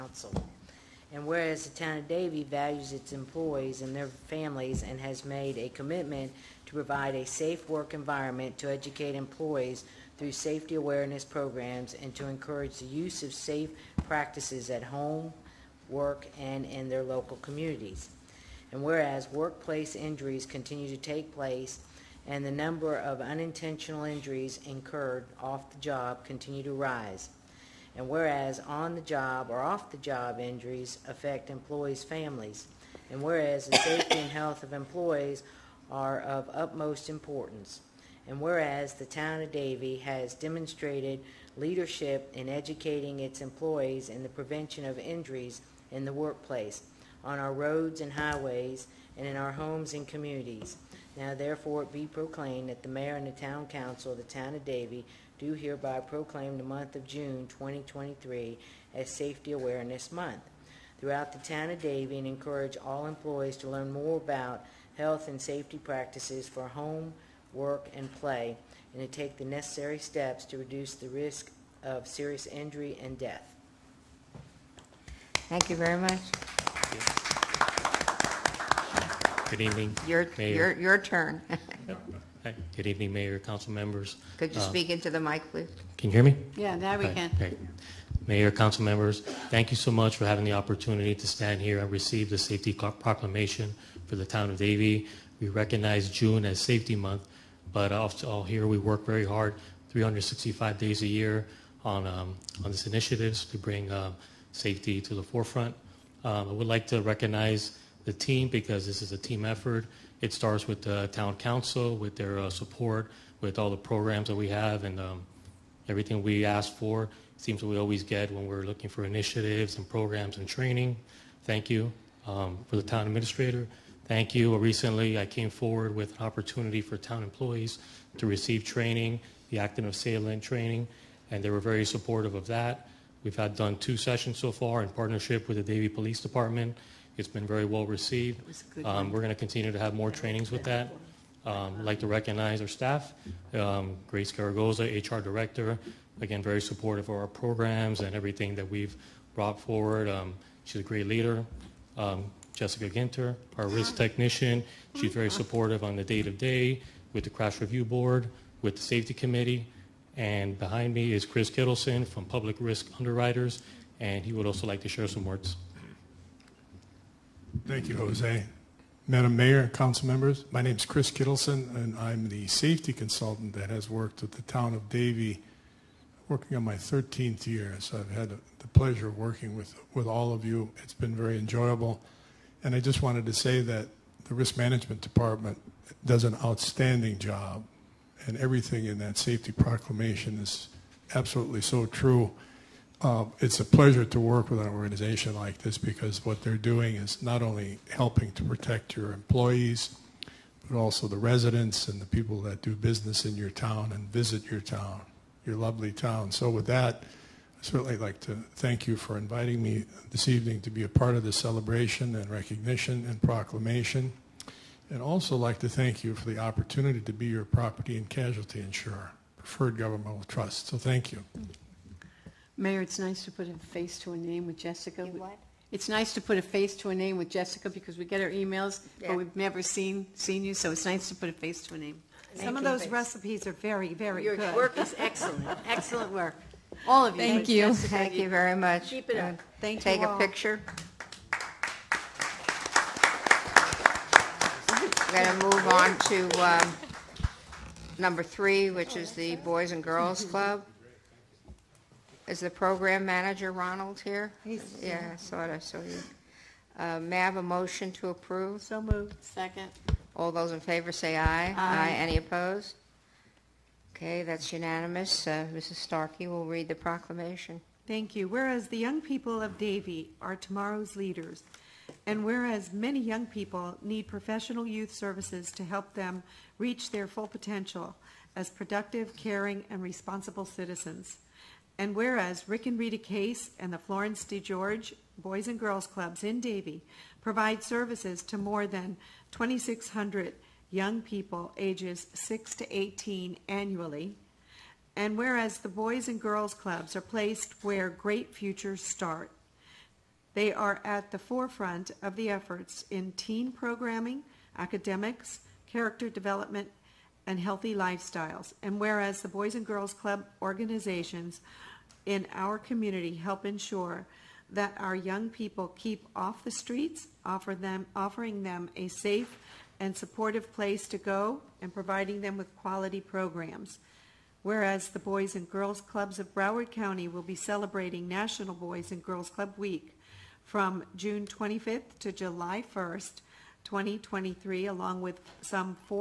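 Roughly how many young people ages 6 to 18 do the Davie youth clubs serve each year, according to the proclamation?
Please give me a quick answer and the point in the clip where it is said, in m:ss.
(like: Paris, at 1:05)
2,600, at 4:49.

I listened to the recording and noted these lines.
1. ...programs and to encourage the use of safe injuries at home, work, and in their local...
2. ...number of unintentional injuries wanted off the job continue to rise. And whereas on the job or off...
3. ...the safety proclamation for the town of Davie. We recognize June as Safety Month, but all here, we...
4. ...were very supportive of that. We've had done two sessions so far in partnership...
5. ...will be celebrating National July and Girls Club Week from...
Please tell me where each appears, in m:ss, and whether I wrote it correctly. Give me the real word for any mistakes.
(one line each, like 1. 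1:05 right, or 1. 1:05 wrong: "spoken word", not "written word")
1. 0:11 wrong: "practices", not "injuries"
2. 0:22 wrong: "incurred", not "wanted"
3. 1:32 right
4. 2:11 right
5. 5:27 wrong: "Boys", not "July".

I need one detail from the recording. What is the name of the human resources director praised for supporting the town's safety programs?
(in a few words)
Grace Garagoza.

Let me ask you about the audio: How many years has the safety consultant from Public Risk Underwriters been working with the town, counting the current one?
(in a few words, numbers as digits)
13th year.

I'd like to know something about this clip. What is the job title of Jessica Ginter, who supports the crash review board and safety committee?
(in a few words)
Risk technician.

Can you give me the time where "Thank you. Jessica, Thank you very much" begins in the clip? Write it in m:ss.
3:57.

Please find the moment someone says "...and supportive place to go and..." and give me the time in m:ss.
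5:19.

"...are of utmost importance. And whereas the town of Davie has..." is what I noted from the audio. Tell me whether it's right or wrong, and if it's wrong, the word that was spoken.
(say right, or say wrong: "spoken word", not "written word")
right.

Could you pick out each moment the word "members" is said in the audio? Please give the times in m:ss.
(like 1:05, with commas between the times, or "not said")
1:23, 1:28, 2:50.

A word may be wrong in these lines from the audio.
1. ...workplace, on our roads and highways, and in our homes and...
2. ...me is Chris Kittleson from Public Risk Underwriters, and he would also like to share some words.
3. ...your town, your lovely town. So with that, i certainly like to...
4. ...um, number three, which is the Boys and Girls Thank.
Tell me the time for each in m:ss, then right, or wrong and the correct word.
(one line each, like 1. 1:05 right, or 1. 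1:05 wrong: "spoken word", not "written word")
1. 0:46 right
2. 2:40 right
3. 3:24 right
4. 4:06 wrong: "Club", not "Thank".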